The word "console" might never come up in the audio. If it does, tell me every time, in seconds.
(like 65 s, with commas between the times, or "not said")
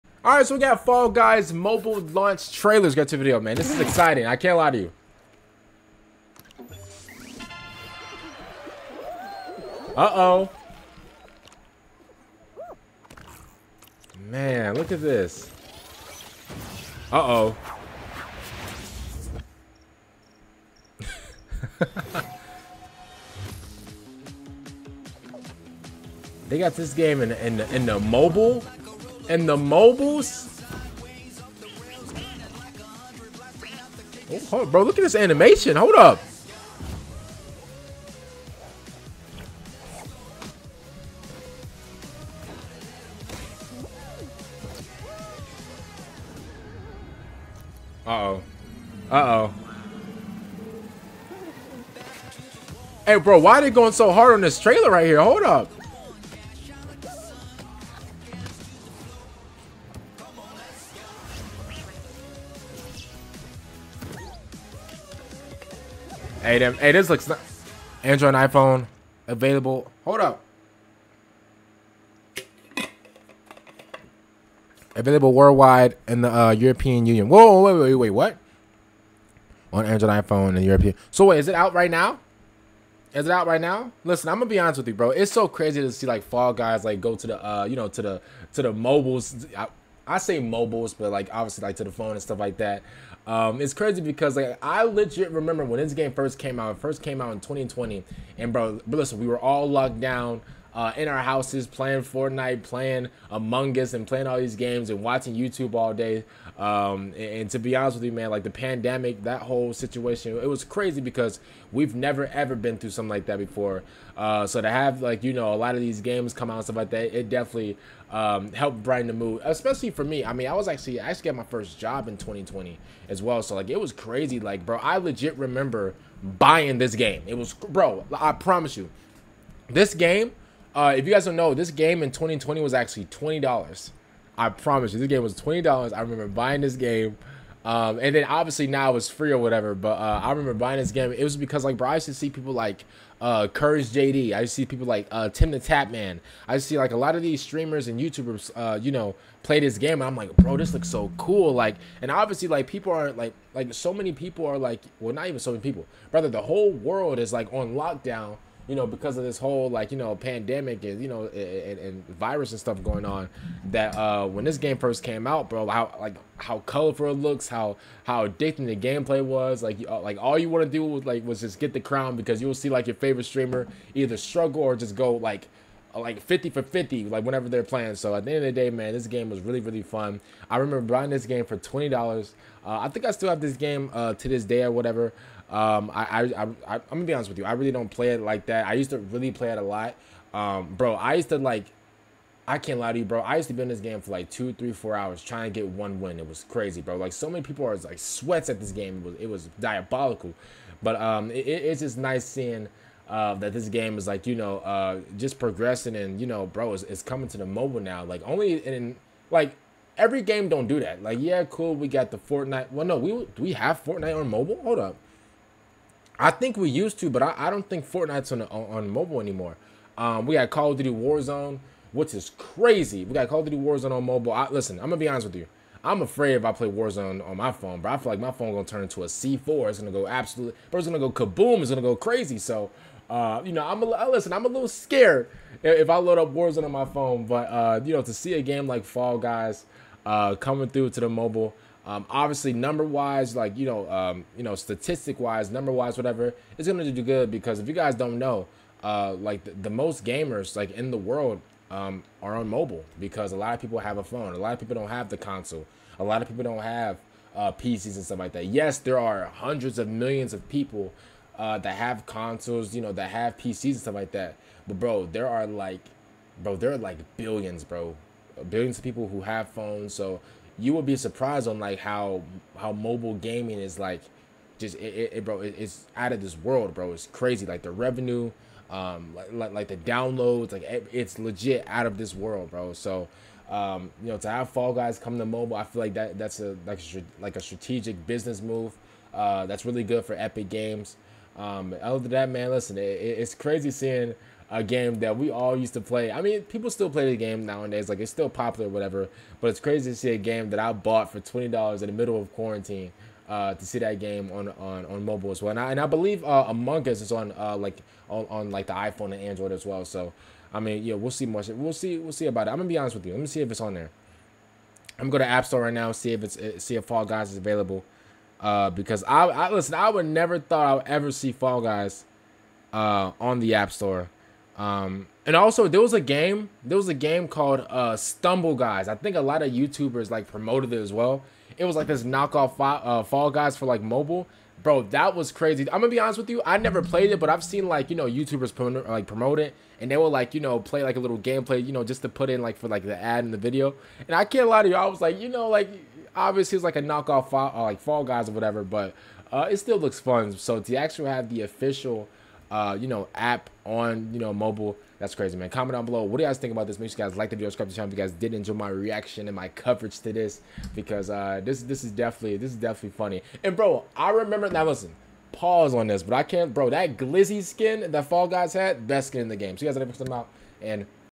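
255 s, 262 s.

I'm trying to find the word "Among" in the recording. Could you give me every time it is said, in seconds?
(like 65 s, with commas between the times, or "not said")
103 s, 306 s.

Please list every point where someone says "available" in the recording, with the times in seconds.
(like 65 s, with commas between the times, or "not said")
69 s, 74 s, 317 s.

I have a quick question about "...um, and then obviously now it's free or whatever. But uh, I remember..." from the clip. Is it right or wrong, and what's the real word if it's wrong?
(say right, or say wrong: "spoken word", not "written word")
right.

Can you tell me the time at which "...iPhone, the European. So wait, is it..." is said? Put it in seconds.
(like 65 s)
80 s.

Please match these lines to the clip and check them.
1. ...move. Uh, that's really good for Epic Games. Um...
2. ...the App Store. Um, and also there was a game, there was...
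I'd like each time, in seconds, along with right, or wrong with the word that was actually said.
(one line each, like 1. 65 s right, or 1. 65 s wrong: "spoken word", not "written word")
1. 288 s right
2. 323 s right.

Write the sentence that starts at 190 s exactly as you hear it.
Um, bro, I used to like, I can't lie to you, bro.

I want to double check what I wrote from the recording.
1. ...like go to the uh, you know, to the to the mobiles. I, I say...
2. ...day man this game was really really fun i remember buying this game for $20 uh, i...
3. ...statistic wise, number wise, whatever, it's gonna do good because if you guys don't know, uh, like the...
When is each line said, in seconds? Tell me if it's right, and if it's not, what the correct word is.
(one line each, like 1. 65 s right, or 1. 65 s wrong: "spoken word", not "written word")
1. 86 s right
2. 178 s right
3. 244 s right.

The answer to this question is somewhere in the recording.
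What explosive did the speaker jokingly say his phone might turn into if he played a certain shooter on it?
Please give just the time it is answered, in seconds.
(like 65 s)
229 s.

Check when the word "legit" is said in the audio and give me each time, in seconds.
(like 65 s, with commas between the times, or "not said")
94 s, 124 s, 281 s.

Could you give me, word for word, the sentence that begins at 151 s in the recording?
Like, and obviously, like people are like, like so many people are like, well, not even so many people, brother.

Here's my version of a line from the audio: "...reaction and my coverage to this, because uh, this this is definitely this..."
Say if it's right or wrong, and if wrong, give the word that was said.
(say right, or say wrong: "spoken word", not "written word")
right.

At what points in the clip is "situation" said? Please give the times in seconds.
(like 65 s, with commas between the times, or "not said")
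109 s.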